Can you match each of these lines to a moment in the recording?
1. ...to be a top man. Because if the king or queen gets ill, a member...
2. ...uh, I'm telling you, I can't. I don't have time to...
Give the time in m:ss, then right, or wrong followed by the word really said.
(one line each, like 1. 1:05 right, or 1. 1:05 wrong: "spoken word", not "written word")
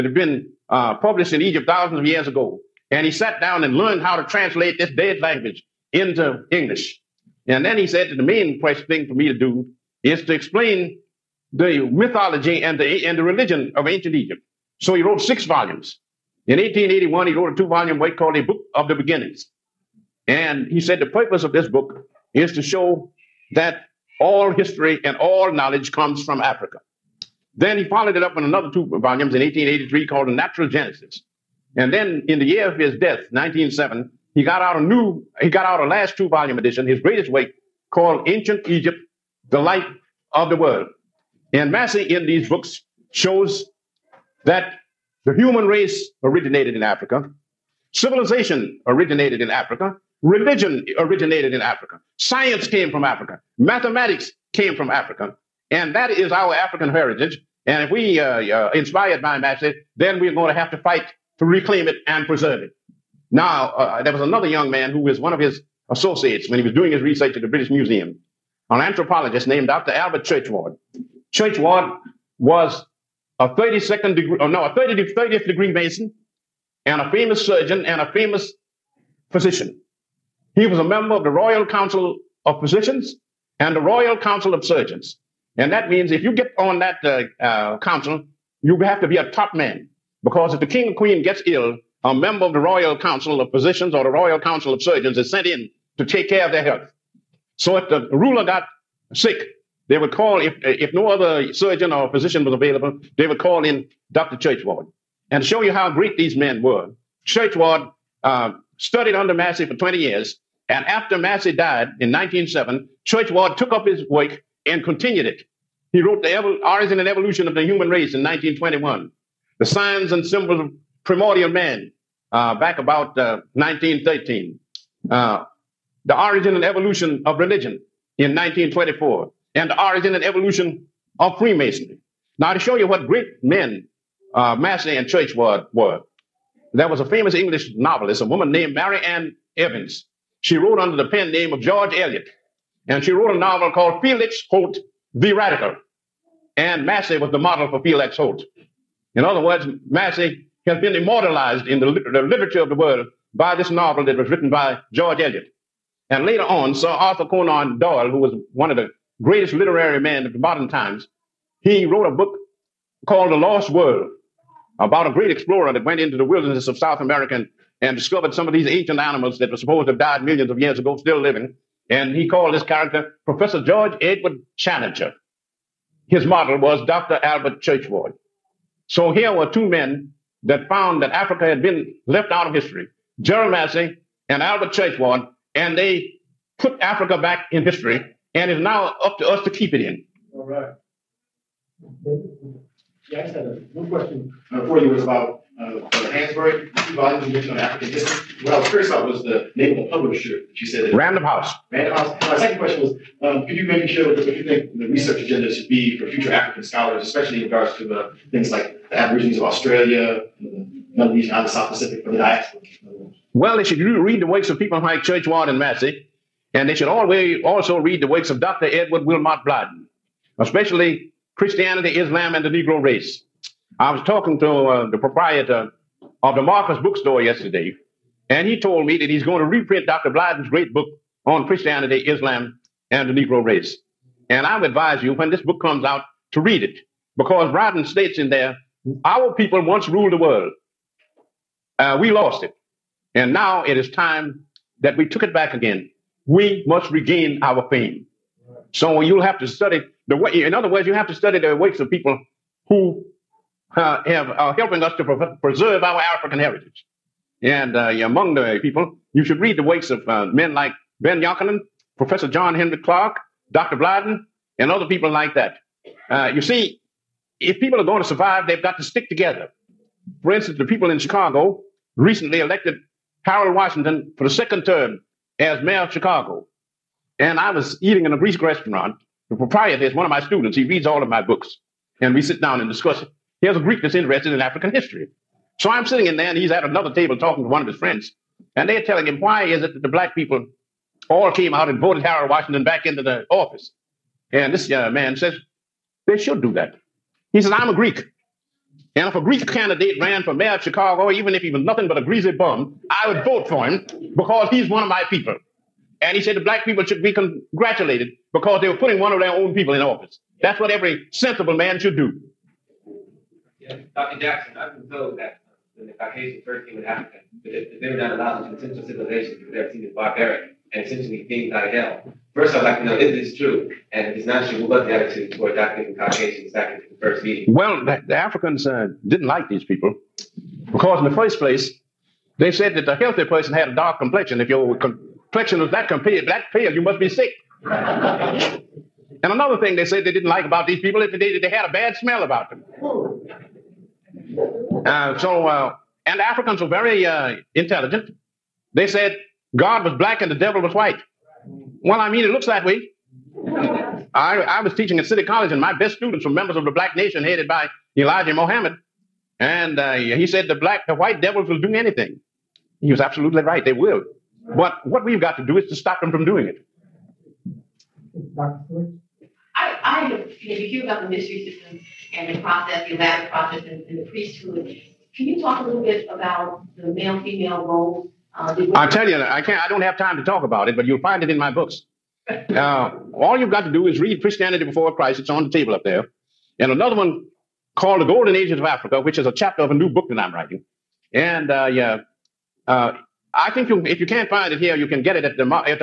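1. 1:29 right
2. 6:18 right.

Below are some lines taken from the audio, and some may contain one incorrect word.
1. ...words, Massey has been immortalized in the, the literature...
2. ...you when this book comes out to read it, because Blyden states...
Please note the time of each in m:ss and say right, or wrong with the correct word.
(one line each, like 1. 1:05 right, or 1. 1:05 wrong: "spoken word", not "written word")
1. 2:29 right
2. 3:55 right.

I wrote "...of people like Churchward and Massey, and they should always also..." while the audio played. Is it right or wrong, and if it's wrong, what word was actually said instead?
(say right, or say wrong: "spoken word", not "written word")
right.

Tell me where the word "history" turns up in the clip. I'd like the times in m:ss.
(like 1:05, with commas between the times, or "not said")
0:24, 3:02, 3:07, 3:17, 4:44.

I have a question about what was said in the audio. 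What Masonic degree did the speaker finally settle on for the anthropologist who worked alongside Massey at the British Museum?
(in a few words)
30th degree.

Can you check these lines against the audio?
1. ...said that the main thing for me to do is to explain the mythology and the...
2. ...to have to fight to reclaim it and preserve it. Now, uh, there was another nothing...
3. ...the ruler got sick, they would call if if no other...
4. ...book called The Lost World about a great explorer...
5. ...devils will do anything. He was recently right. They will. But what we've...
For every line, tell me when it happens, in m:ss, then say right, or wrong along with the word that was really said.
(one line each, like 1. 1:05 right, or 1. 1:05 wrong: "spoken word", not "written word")
1. 0:07 right
2. 1:00 wrong: "young", not "nothing"
3. 1:37 right
4. 2:42 right
5. 6:01 wrong: "absolutely", not "recently".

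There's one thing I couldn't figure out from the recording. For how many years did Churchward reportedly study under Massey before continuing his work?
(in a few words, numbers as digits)
20.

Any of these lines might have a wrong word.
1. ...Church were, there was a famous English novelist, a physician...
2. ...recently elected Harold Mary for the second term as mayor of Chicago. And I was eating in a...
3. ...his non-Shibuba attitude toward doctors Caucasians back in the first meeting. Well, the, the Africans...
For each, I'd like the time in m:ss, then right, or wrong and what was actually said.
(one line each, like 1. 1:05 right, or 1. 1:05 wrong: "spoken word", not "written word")
1. 2:15 wrong: "woman", not "physician"
2. 4:31 wrong: "Washington", not "Mary"
3. 5:24 right.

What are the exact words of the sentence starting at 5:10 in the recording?
That's what every sensible man should do.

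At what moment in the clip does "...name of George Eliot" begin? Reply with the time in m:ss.
2:21.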